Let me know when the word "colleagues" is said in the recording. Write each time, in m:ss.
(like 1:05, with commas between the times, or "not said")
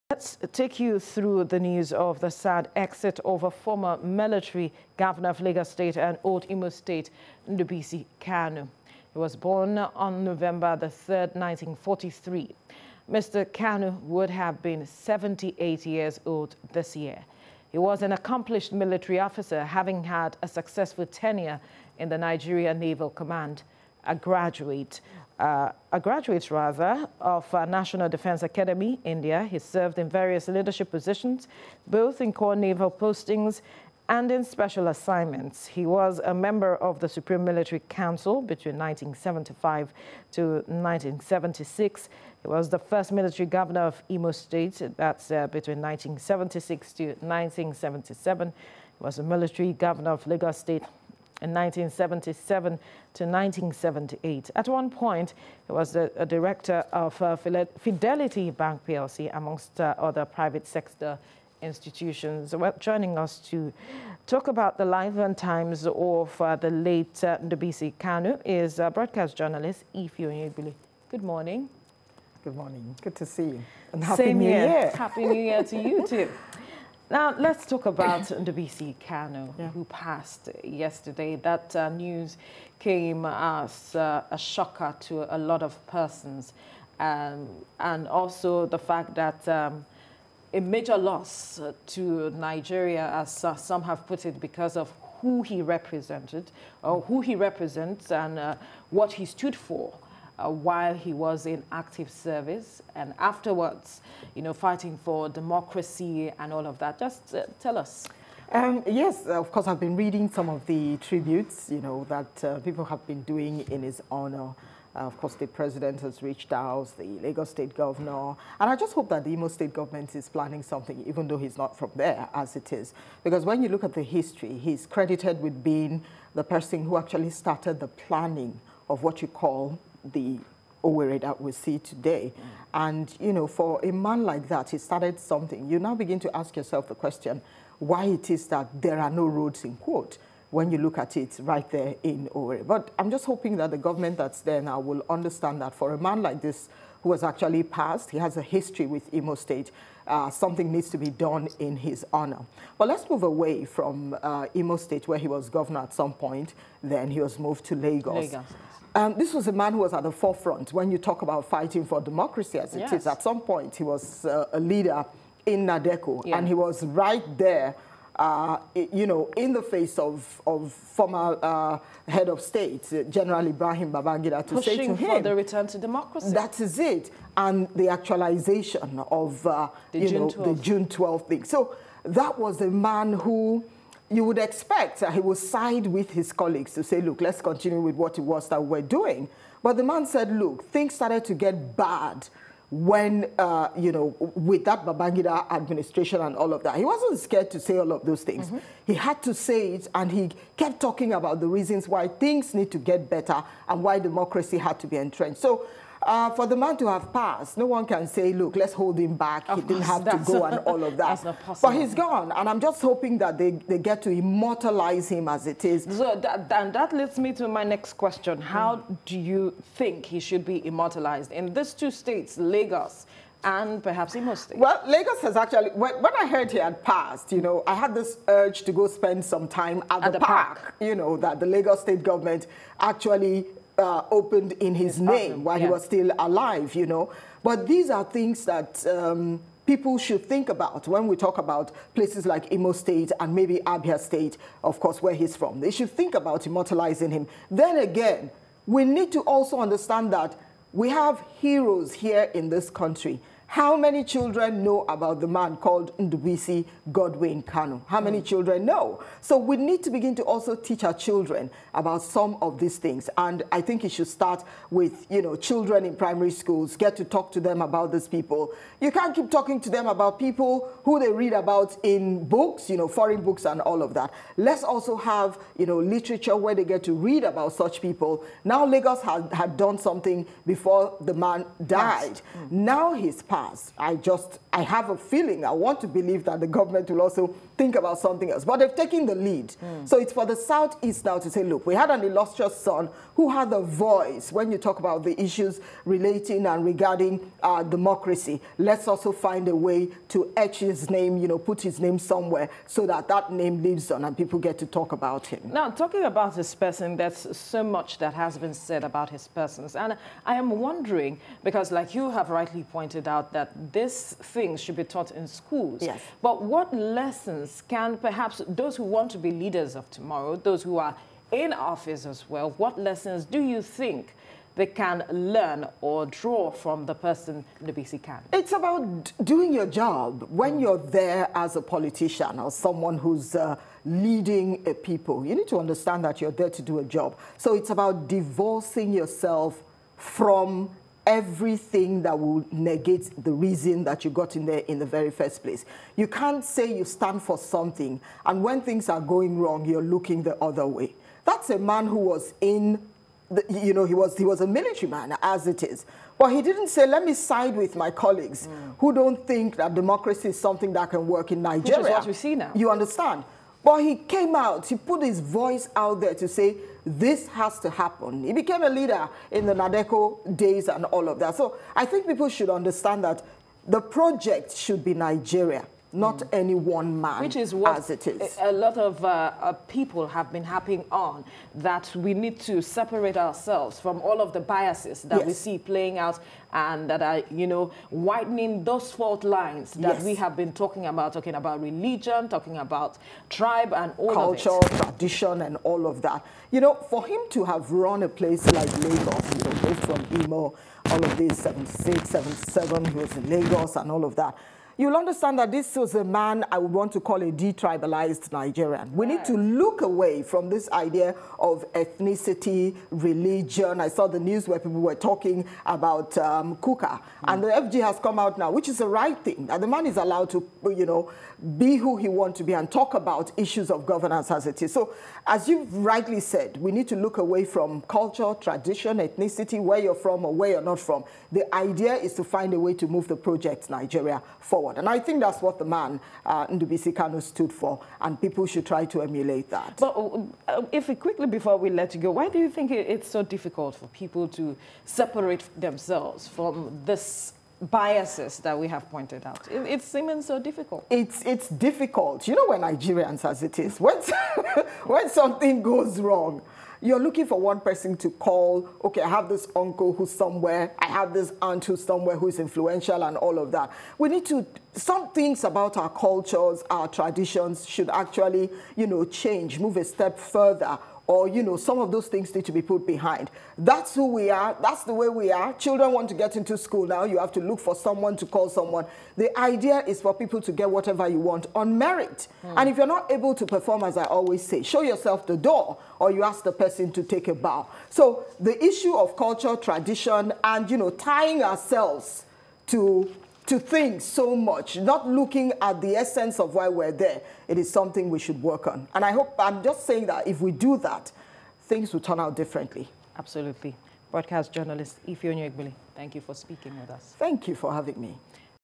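3:06, 5:57.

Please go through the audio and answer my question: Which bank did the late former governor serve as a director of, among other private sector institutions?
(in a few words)
Fidelity Bank PLC.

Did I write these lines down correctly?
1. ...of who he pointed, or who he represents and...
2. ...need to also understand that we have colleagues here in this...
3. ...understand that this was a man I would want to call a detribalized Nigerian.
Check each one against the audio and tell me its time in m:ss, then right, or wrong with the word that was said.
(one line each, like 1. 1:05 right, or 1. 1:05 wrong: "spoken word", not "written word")
1. 1:34 wrong: "represented", not "pointed"
2. 4:08 wrong: "heroes", not "colleagues"
3. 6:44 right.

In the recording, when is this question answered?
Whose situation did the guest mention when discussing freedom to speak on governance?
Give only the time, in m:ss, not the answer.
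6:56.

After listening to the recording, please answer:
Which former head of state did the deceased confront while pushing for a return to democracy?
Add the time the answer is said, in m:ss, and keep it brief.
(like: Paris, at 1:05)
Ibrahim Babangida, at 2:53.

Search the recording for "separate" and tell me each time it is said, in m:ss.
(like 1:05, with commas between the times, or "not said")
6:22, 7:24.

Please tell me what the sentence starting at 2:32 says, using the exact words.
But let's move away from uh, Imo State, where he was governor at some point.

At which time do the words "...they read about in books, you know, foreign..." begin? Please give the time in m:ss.
4:31.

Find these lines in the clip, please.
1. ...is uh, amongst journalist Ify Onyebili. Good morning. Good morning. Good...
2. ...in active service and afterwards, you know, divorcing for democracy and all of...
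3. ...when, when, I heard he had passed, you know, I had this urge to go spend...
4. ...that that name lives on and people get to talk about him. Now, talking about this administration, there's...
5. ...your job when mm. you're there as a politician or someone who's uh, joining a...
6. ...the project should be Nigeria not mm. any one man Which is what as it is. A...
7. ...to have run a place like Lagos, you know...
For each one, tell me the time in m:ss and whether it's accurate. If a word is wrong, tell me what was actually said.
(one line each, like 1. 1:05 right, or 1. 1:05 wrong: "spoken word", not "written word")
1. 1:08 wrong: "broadcast", not "amongst"
2. 1:41 wrong: "fighting", not "divorcing"
3. 3:45 right
4. 5:02 wrong: "person", not "administration"
5. 5:29 wrong: "leading", not "joining"
6. 6:13 right
7. 6:37 right.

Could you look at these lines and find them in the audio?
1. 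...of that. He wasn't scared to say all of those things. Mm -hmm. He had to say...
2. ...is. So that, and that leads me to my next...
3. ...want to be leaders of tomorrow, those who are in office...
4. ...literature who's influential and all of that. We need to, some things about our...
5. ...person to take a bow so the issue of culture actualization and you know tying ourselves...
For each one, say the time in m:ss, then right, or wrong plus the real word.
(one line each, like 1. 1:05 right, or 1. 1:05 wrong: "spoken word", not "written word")
1. 3:16 right
2. 3:35 right
3. 5:18 right
4. 7:41 wrong: "somewhere", not "literature"
5. 8:06 wrong: "tradition", not "actualization".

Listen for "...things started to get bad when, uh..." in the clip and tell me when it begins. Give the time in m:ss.
3:10.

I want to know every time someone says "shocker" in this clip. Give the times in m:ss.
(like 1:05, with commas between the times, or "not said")
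1:24.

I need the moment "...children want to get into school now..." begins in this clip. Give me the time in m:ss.
7:55.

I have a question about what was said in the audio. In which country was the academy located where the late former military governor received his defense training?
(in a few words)
India.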